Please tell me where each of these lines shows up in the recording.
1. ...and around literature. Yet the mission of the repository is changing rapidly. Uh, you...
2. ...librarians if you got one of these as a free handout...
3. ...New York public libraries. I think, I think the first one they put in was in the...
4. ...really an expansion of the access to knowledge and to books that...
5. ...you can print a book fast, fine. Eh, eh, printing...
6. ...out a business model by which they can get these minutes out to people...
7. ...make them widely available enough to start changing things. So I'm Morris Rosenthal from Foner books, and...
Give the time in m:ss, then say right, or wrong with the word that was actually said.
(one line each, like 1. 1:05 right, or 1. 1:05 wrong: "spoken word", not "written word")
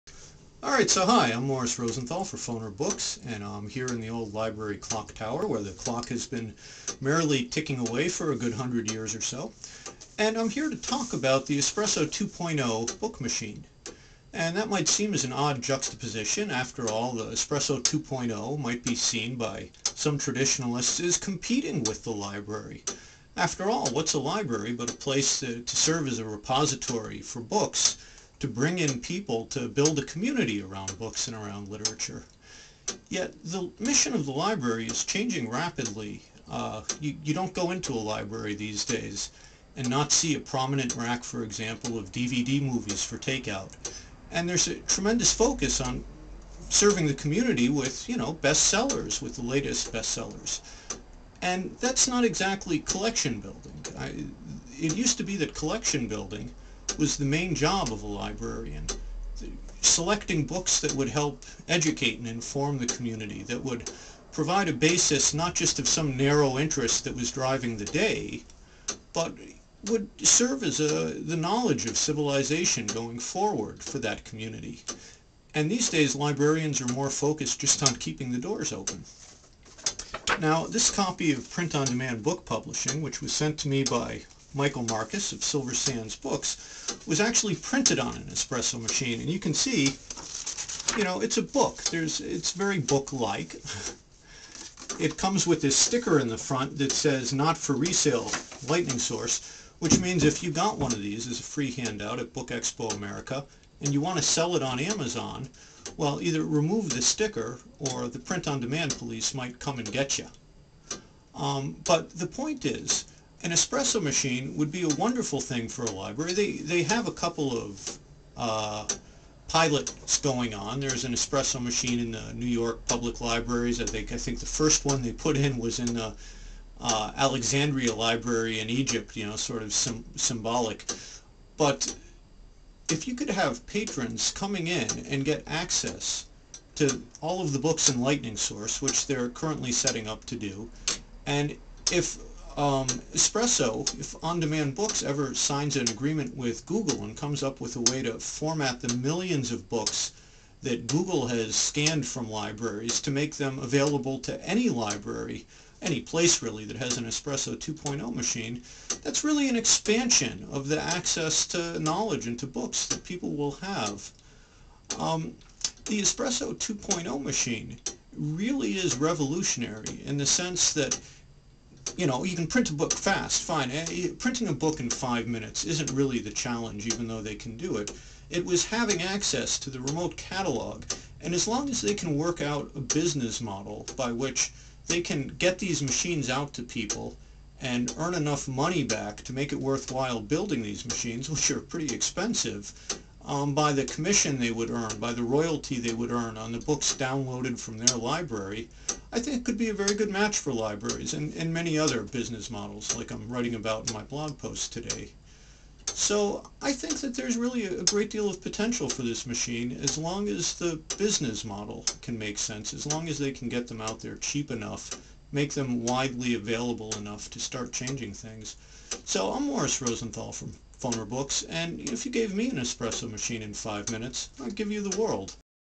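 1. 0:31 wrong: "library", not "repository"
2. 1:40 wrong: "means", not "librarians"
3. 2:02 right
4. 2:39 right
5. 2:52 right
6. 3:02 wrong: "machines", not "minutes"
7. 3:35 right.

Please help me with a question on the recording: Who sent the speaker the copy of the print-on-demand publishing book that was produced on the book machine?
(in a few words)
Michael Marcus.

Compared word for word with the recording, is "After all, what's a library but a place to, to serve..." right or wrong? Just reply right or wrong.
right.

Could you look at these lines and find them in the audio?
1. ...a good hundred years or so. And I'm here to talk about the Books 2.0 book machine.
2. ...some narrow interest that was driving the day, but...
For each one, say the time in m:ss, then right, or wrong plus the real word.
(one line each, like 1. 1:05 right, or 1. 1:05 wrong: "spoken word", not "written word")
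1. 0:08 wrong: "Espresso", not "Books"
2. 1:05 right.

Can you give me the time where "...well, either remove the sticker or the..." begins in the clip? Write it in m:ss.
1:45.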